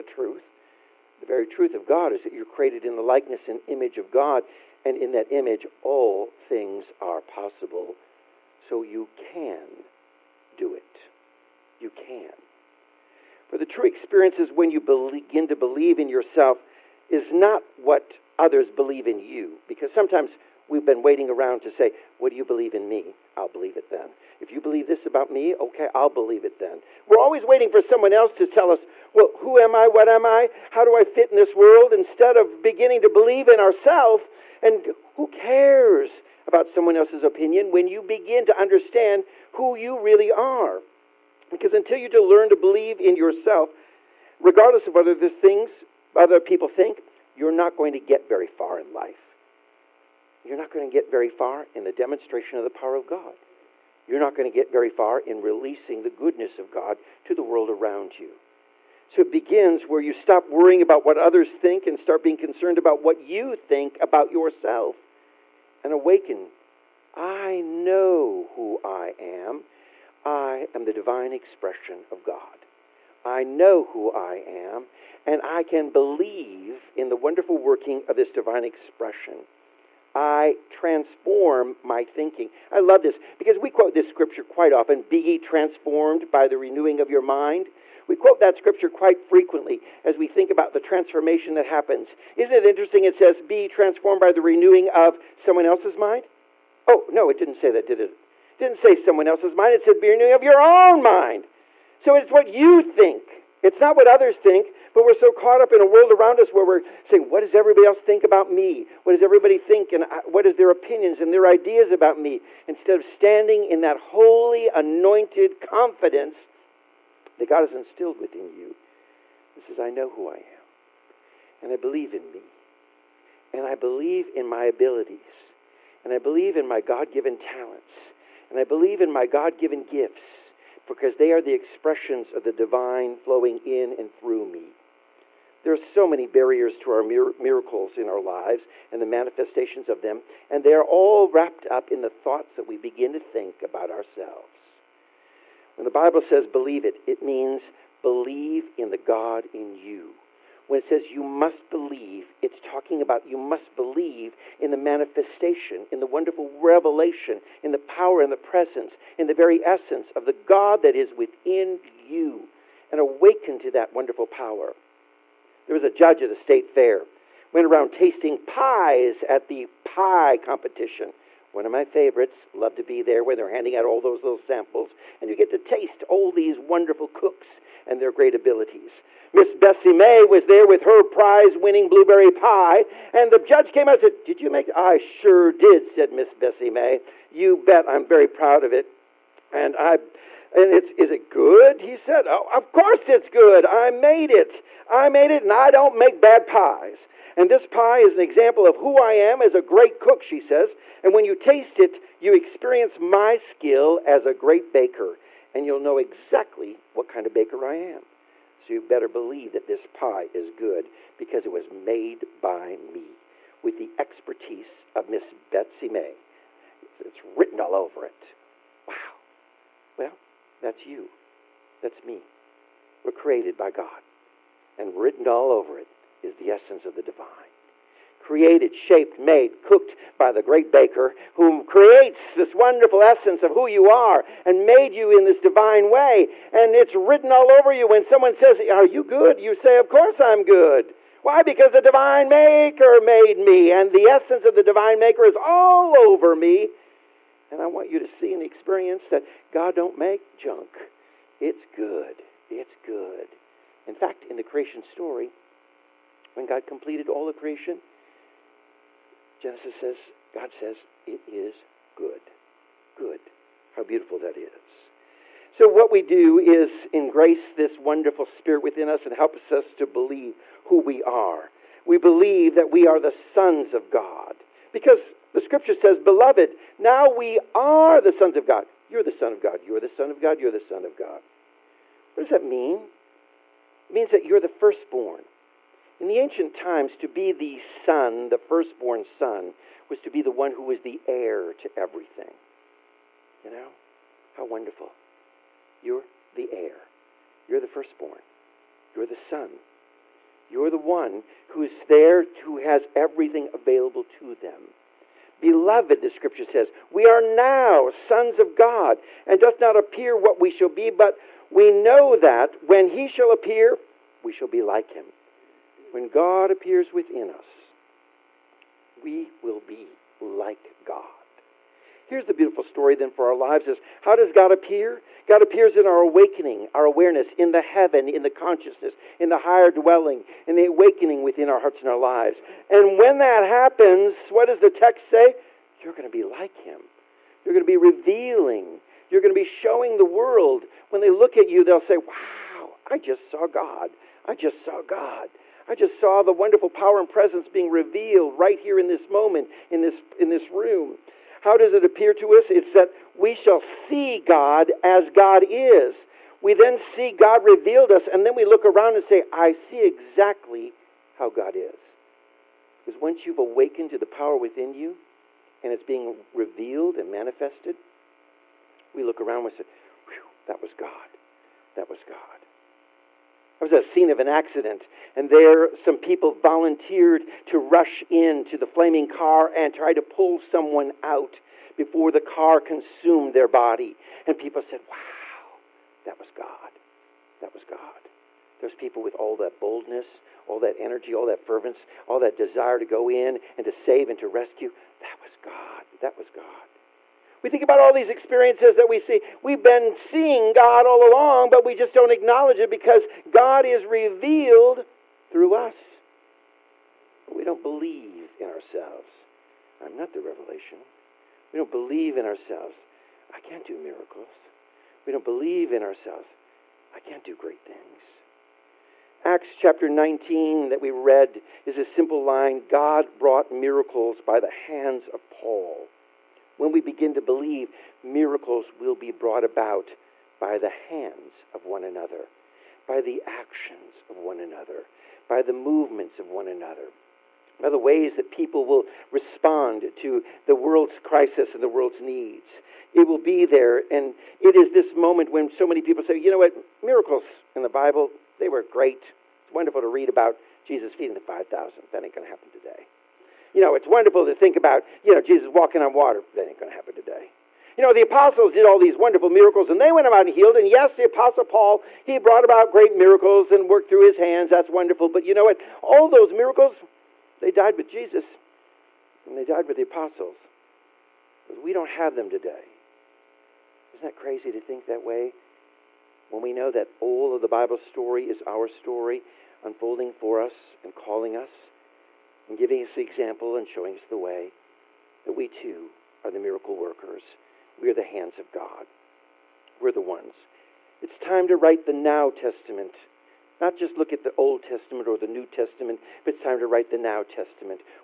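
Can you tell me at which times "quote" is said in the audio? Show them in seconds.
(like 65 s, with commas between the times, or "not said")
83 s, 88 s.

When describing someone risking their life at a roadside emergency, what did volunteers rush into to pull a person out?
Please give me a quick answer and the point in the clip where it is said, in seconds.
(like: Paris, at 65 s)
Flaming car, at 378 s.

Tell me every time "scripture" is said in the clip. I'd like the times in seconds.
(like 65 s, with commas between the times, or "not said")
84 s, 88 s, 275 s, 306 s.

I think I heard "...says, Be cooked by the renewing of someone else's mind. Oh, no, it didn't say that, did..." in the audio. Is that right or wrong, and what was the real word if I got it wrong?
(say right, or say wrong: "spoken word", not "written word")
wrong: "transformed", not "cooked".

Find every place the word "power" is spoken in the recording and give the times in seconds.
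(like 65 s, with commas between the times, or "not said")
52 s, 157 s, 164 s, 346 s, 364 s.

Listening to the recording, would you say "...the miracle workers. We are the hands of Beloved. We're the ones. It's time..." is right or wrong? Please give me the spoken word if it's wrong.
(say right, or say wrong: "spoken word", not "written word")
wrong: "God", not "Beloved".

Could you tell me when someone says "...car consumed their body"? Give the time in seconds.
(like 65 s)
382 s.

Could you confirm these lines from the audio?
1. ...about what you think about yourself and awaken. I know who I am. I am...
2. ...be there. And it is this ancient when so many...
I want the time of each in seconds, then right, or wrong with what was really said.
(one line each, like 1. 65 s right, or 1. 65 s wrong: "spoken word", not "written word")
1. 62 s right
2. 443 s wrong: "moment", not "ancient".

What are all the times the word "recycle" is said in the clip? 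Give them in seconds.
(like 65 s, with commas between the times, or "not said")
not said.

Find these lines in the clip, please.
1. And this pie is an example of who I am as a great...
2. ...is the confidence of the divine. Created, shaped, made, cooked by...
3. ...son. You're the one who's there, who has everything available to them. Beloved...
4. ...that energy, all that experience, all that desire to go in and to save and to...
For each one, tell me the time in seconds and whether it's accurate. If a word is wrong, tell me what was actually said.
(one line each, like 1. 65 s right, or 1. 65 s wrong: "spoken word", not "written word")
1. 197 s right
2. 226 s wrong: "essence", not "confidence"
3. 299 s right
4. 390 s wrong: "fervence", not "experience".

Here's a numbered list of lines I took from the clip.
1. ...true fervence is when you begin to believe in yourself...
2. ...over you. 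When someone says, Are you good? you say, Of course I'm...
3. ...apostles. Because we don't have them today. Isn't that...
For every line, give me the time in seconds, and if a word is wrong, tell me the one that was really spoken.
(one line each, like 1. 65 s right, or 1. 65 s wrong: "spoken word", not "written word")
1. 13 s wrong: "experience", not "fervence"
2. 237 s right
3. 469 s right.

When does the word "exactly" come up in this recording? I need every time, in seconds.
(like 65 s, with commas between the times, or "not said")
205 s, 359 s.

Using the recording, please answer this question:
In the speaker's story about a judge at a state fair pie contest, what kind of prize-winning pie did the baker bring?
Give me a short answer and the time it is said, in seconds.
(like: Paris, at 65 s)
Blueberry, at 181 s.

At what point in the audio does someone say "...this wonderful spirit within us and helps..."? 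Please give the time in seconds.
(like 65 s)
267 s.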